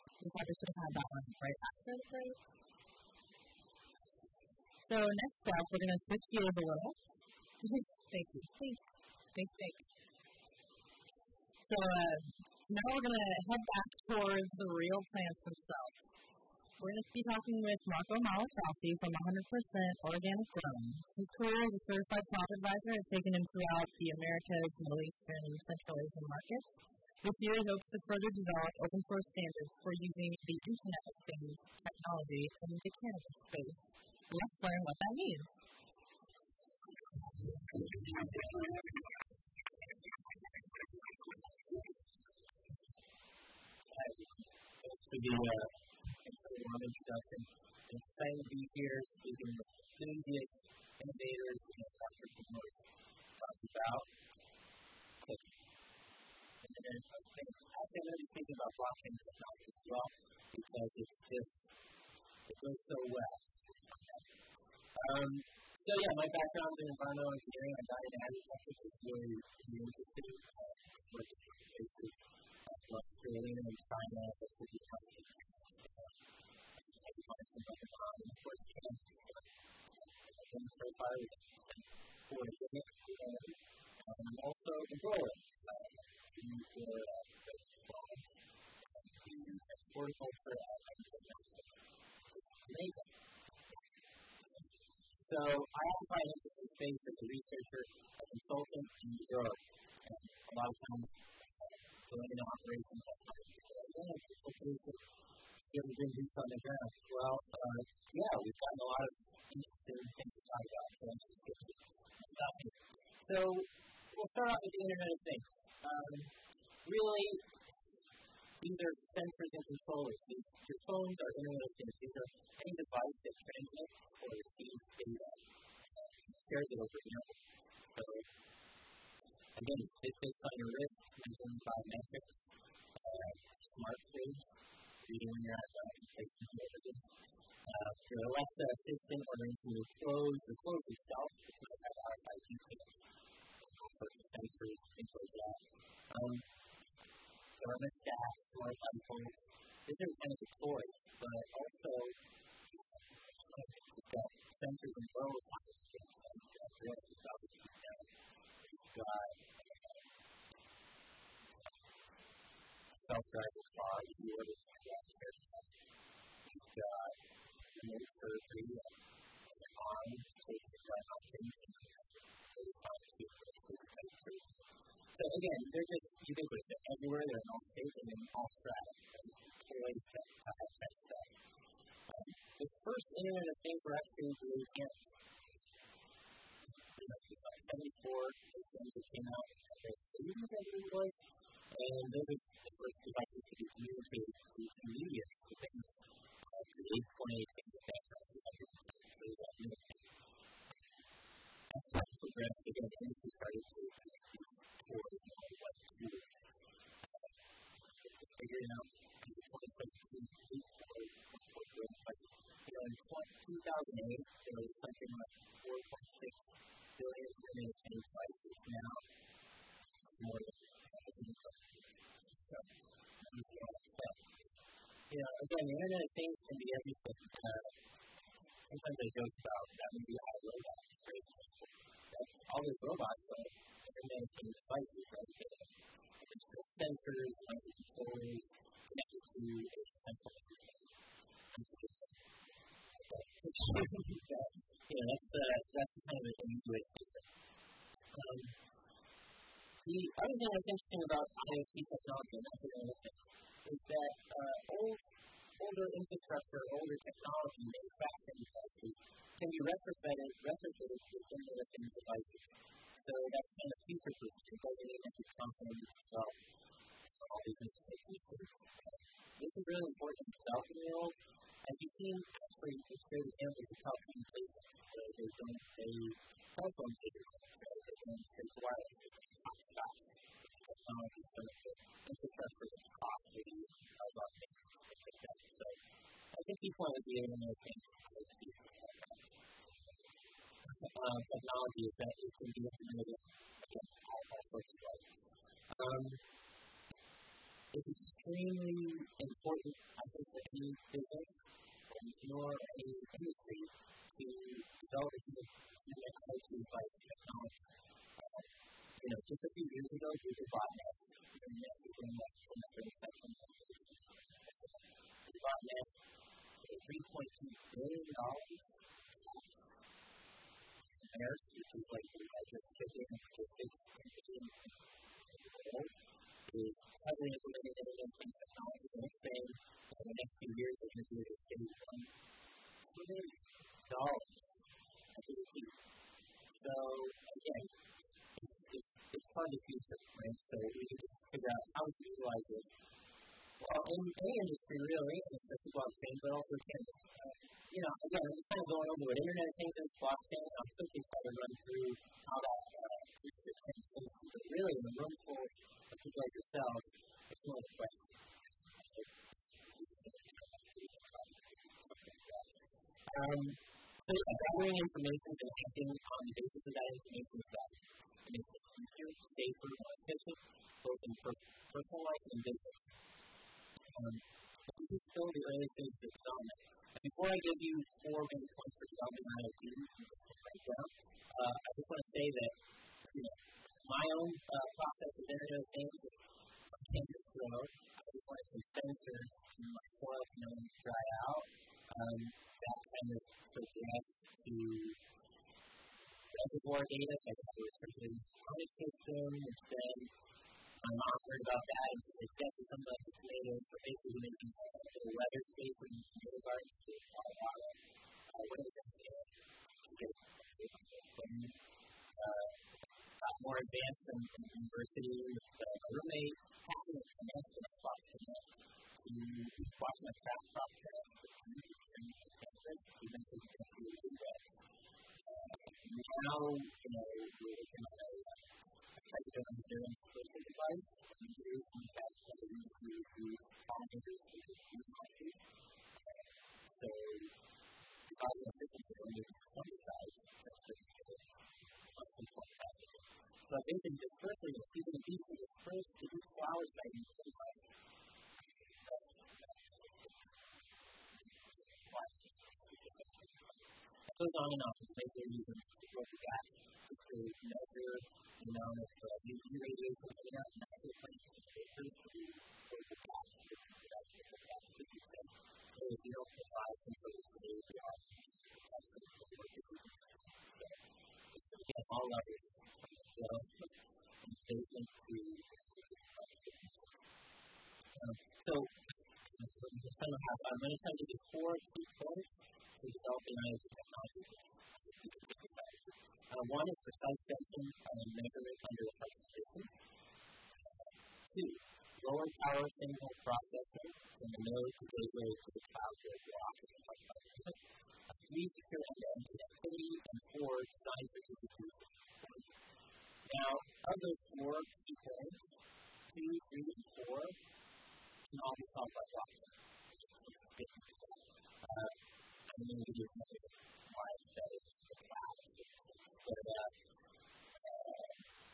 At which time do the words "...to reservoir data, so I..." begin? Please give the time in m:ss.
6:34.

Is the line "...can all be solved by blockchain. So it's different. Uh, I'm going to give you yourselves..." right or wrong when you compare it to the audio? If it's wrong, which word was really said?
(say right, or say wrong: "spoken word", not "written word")
wrong: "examples", not "yourselves".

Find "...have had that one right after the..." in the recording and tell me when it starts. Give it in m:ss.
0:00.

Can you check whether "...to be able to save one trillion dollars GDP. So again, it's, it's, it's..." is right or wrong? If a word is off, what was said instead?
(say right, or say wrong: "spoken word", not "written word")
right.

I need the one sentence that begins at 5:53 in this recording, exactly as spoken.
So really, in a room full of people like yourselves, it's not a question.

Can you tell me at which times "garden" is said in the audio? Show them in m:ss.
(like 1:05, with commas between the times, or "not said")
6:46.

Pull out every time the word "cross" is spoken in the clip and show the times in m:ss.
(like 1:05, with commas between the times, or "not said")
6:57.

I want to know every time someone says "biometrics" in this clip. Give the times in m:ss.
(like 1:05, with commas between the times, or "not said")
2:11.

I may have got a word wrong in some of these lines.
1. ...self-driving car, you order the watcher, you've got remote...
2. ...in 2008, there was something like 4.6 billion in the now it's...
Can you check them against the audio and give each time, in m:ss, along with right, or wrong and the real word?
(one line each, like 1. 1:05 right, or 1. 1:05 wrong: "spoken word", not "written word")
1. 2:43 right
2. 3:32 right.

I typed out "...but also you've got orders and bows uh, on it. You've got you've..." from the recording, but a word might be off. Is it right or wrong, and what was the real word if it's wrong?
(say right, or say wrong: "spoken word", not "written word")
wrong: "sensors", not "orders".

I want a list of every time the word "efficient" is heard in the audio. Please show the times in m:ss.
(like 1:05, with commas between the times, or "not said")
6:10.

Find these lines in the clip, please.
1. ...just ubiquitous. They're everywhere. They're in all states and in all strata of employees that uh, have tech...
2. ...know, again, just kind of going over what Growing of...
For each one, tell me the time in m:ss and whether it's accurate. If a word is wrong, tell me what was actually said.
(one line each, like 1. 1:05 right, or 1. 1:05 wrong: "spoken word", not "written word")
1. 2:55 right
2. 5:47 wrong: "Internet", not "Growing".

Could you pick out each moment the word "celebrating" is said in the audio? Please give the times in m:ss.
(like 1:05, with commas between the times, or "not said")
not said.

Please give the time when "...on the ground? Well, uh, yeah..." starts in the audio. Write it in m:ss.
1:46.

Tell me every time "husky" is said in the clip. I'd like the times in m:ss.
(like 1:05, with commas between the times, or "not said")
not said.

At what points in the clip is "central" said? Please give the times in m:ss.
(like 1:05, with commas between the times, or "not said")
0:25, 3:59.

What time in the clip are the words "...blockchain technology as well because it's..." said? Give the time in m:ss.
0:58.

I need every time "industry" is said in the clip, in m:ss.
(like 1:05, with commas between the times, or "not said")
5:03, 5:44.